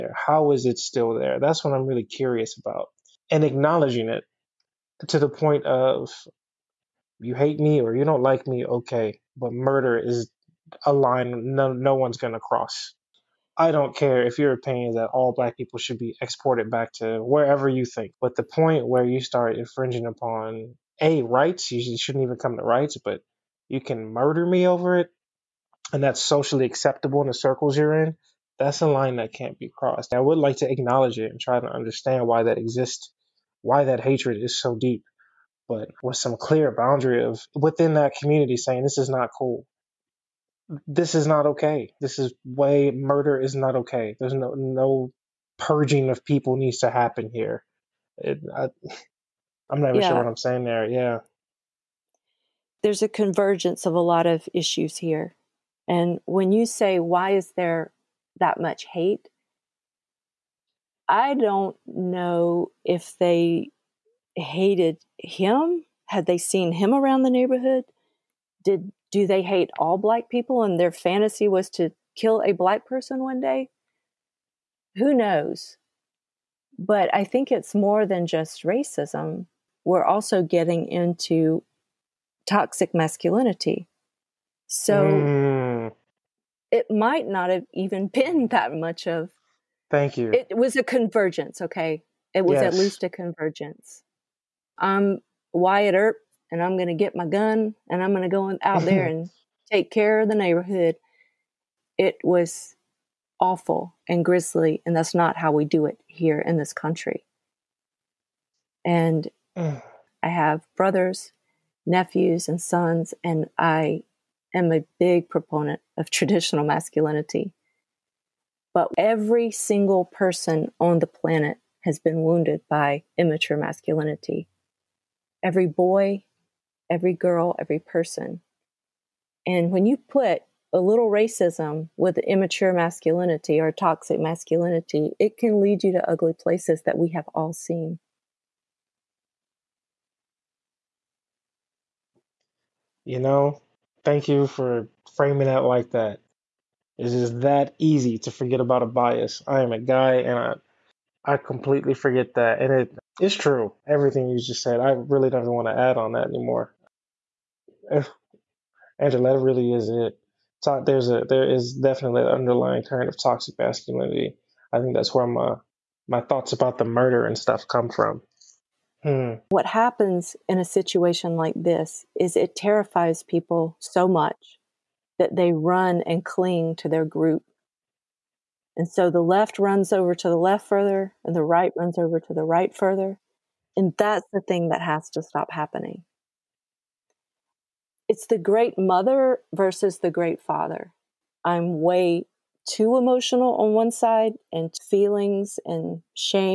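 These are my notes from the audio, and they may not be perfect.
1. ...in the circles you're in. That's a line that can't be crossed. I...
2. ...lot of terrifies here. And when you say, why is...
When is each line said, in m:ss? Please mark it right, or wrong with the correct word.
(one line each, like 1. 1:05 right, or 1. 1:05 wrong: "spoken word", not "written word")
1. 0:27 right
2. 0:53 wrong: "issues", not "terrifies".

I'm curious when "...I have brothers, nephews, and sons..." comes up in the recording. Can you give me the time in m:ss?
1:49.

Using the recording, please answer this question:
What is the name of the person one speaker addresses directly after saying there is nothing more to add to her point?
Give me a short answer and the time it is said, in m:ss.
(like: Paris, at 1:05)
Angela, at 2:38.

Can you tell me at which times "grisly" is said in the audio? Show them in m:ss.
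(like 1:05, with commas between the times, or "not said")
1:44.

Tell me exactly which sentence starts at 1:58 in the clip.
But every single person on the planet has been wounded by immature masculinity.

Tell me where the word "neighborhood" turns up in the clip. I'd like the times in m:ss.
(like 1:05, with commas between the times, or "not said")
1:07, 1:40.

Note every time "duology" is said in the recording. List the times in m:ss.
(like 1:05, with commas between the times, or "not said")
not said.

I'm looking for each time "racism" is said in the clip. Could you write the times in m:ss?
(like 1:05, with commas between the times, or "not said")
1:18, 2:11.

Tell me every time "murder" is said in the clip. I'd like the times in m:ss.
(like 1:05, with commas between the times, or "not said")
0:09, 0:24, 0:42, 2:46.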